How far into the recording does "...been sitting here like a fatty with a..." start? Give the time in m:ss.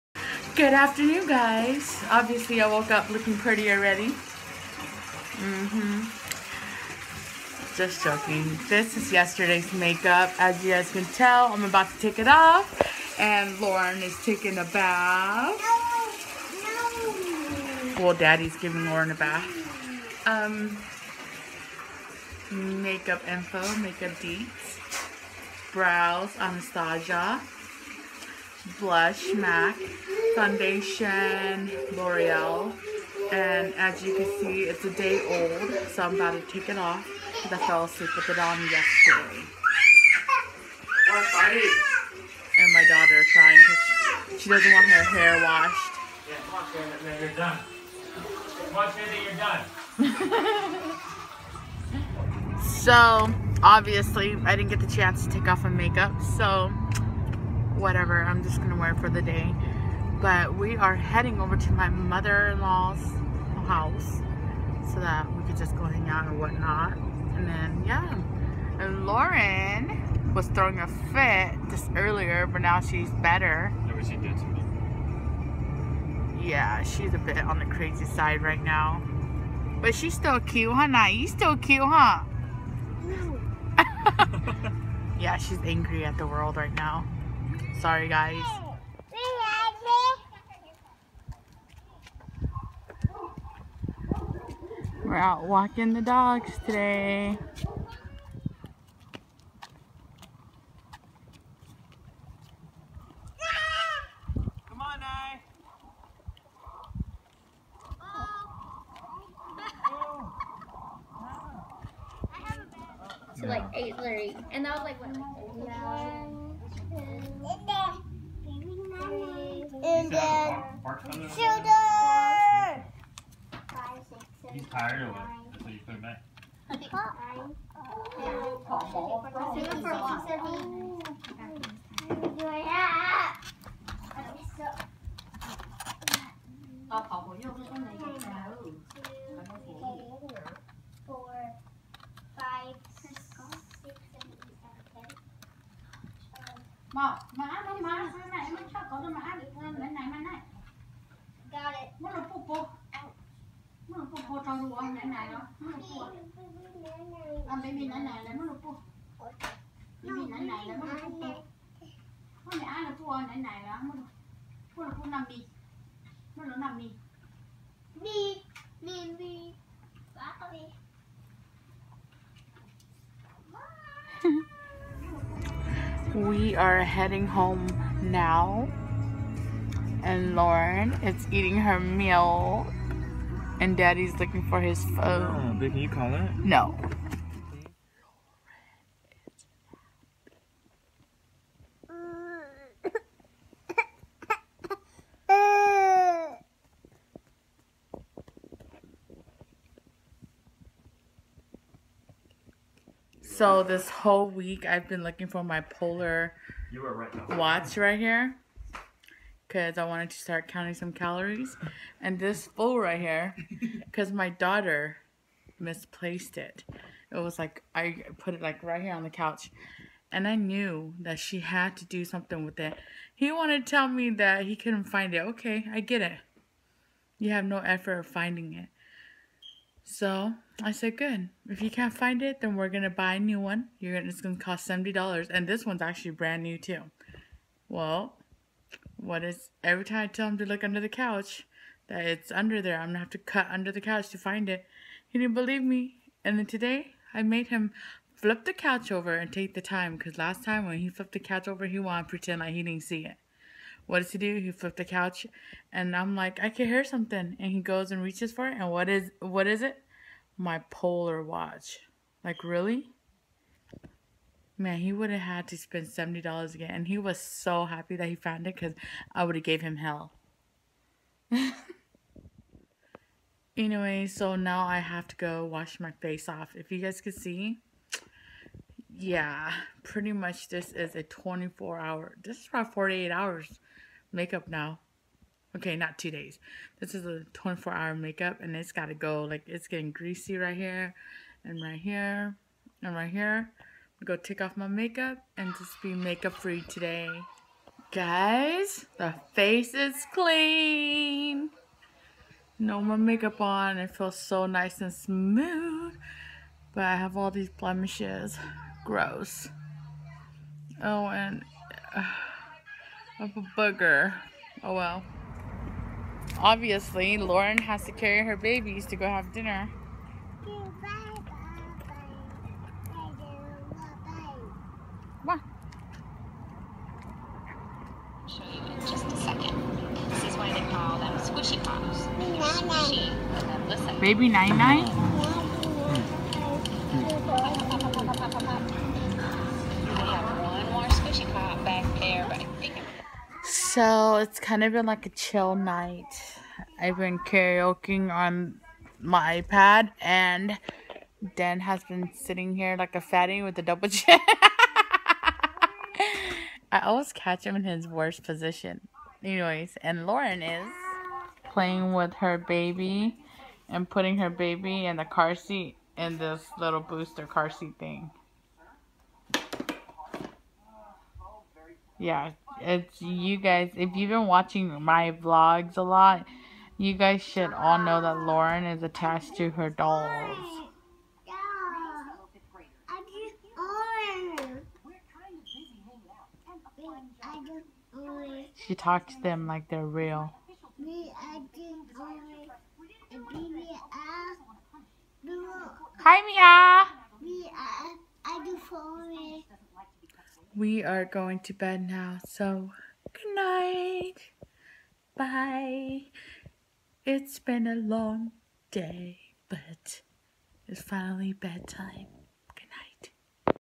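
5:51.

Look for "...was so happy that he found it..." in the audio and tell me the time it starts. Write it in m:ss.
4:26.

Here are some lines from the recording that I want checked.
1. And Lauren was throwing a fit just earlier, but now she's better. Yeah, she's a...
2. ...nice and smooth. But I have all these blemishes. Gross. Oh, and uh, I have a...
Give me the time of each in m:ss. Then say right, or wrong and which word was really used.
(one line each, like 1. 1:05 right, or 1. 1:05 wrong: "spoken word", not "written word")
1. 1:08 right
2. 5:04 right.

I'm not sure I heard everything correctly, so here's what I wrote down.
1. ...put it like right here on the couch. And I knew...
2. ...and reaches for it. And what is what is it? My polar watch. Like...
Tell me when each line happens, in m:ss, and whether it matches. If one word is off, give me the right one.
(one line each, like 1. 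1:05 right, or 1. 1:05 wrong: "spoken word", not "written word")
1. 3:38 right
2. 4:17 right.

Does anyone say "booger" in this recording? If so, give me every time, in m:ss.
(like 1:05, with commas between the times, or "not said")
5:13.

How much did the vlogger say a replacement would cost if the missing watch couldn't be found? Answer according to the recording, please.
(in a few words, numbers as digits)
$70.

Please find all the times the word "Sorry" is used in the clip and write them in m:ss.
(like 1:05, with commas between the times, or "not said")
1:27.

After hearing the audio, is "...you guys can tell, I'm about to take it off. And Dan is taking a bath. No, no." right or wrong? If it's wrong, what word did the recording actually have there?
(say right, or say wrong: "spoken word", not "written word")
wrong: "Lauren", not "Dan".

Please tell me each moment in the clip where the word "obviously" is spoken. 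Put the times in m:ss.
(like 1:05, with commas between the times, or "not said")
0:02, 0:53, 5:16.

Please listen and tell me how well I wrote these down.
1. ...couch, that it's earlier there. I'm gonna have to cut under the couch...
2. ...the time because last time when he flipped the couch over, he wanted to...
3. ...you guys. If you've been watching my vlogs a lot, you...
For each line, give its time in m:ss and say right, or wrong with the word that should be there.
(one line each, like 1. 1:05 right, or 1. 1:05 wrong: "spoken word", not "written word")
1. 4:00 wrong: "under", not "earlier"
2. 4:09 right
3. 6:13 right.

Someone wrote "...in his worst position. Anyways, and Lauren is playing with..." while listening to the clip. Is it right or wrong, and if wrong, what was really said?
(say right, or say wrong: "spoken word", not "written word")
right.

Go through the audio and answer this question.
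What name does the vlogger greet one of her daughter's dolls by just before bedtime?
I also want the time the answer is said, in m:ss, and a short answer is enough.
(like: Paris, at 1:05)
Mia, at 6:36.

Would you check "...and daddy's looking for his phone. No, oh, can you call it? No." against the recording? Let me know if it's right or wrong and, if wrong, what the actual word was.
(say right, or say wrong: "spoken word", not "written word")
right.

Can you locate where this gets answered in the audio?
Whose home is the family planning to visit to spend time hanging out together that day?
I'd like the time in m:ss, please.
1:01.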